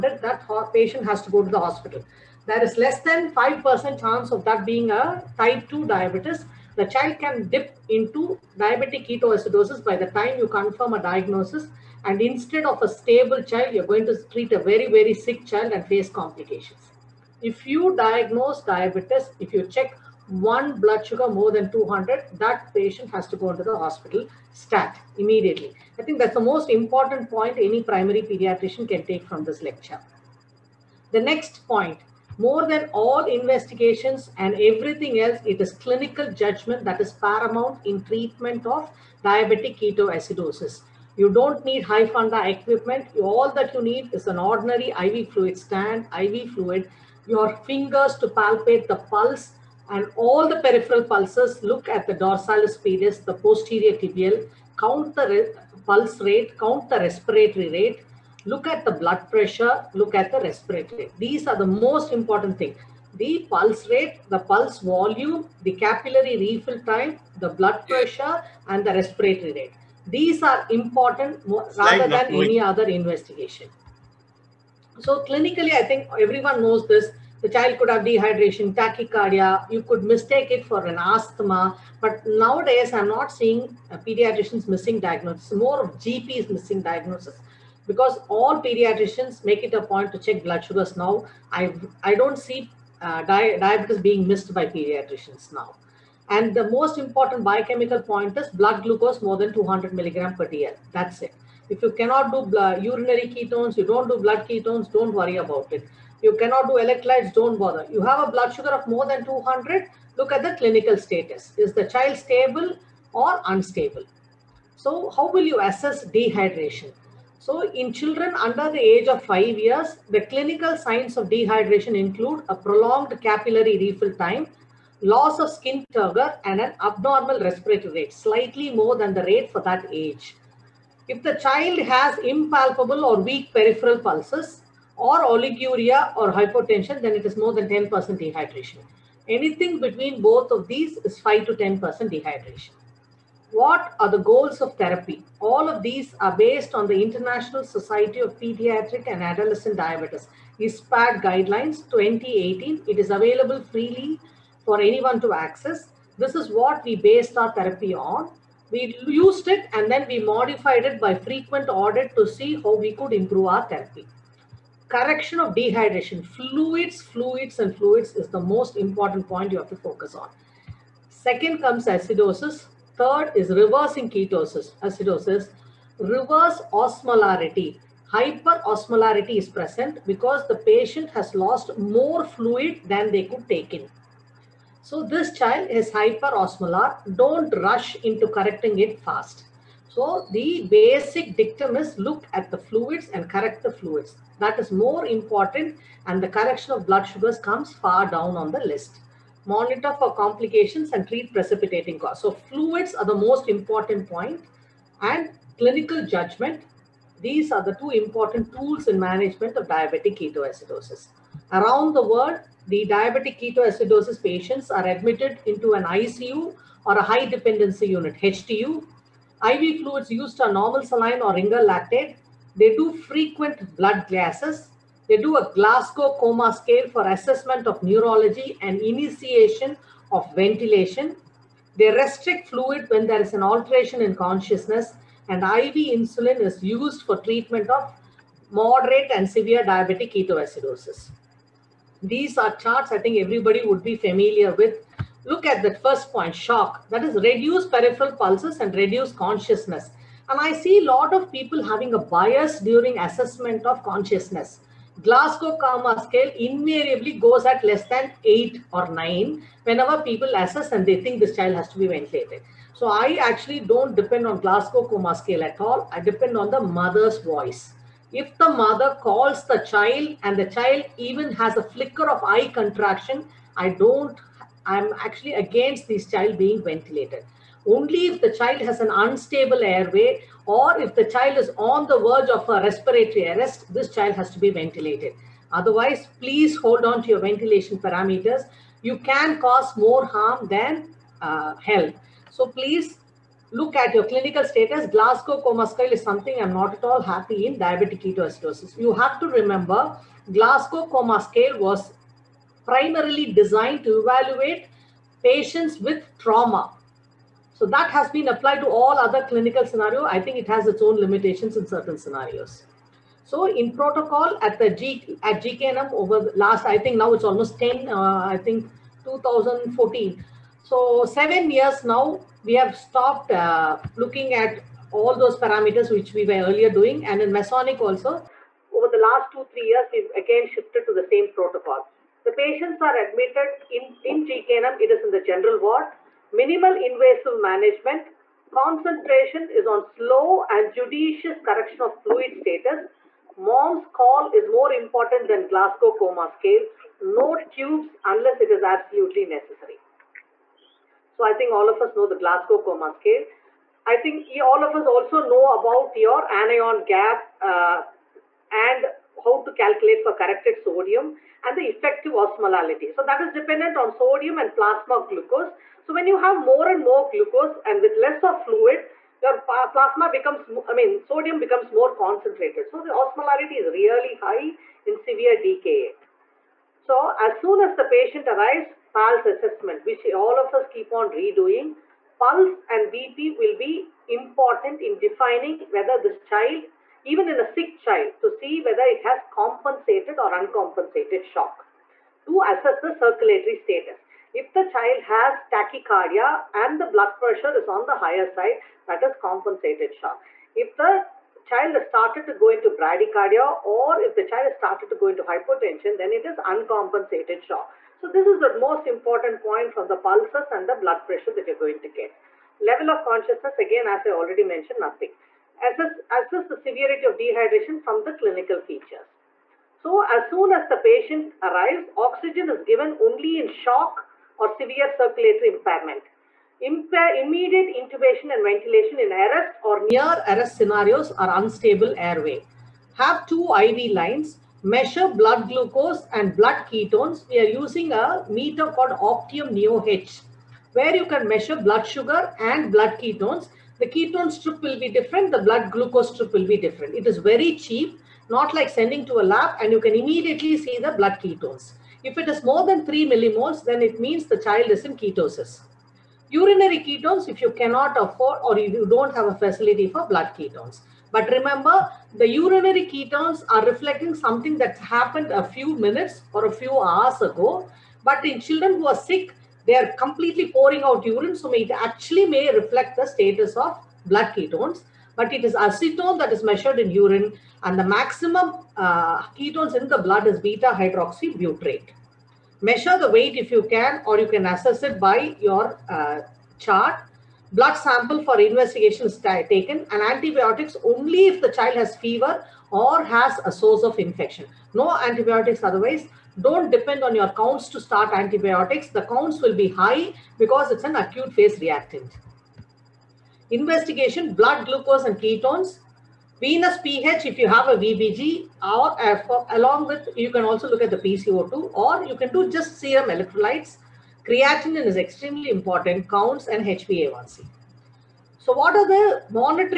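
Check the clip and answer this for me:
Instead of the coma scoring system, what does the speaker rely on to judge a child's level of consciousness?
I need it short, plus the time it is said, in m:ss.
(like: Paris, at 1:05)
the mother's voice, at 4:26.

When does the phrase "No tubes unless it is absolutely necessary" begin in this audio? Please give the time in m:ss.
5:47.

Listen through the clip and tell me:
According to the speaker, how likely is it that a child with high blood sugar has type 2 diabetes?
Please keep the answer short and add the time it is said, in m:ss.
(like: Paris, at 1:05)
less than 5%, at 0:02.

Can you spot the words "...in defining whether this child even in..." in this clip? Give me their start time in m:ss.
6:24.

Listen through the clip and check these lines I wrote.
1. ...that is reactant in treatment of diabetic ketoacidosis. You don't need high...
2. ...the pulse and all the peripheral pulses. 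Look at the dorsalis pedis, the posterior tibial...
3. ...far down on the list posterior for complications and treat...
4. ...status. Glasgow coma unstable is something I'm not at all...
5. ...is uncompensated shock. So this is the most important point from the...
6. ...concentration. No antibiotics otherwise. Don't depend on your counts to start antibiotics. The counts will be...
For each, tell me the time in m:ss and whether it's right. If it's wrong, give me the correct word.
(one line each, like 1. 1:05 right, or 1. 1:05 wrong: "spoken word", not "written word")
1. 0:36 wrong: "paramount", not "reactant"
2. 0:48 right
3. 3:17 wrong: "monitor", not "posterior"
4. 4:54 wrong: "scale", not "unstable"
5. 6:46 right
6. 8:13 wrong: "infection", not "concentration".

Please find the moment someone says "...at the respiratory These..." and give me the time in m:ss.
1:00.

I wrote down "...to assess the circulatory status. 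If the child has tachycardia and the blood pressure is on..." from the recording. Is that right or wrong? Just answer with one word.
right.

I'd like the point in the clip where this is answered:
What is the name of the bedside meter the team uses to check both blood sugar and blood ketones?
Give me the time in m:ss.
7:19.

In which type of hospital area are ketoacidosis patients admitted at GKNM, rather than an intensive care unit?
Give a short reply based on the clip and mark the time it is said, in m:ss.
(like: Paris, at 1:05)
general ward, at 5:35.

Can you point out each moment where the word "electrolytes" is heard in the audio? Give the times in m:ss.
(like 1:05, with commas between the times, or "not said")
1:46, 8:33.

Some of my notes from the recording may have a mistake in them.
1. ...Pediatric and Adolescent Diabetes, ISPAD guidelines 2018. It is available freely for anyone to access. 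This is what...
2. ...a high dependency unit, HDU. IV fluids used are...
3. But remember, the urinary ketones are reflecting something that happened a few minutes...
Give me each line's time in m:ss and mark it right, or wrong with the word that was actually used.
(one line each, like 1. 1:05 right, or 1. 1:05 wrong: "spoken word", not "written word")
1. 2:28 right
2. 3:36 right
3. 7:41 right.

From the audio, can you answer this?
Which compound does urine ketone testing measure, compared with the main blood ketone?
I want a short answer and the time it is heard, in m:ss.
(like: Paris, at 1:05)
acetone, at 7:55.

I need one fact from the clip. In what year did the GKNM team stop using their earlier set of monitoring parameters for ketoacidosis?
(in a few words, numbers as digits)
2014.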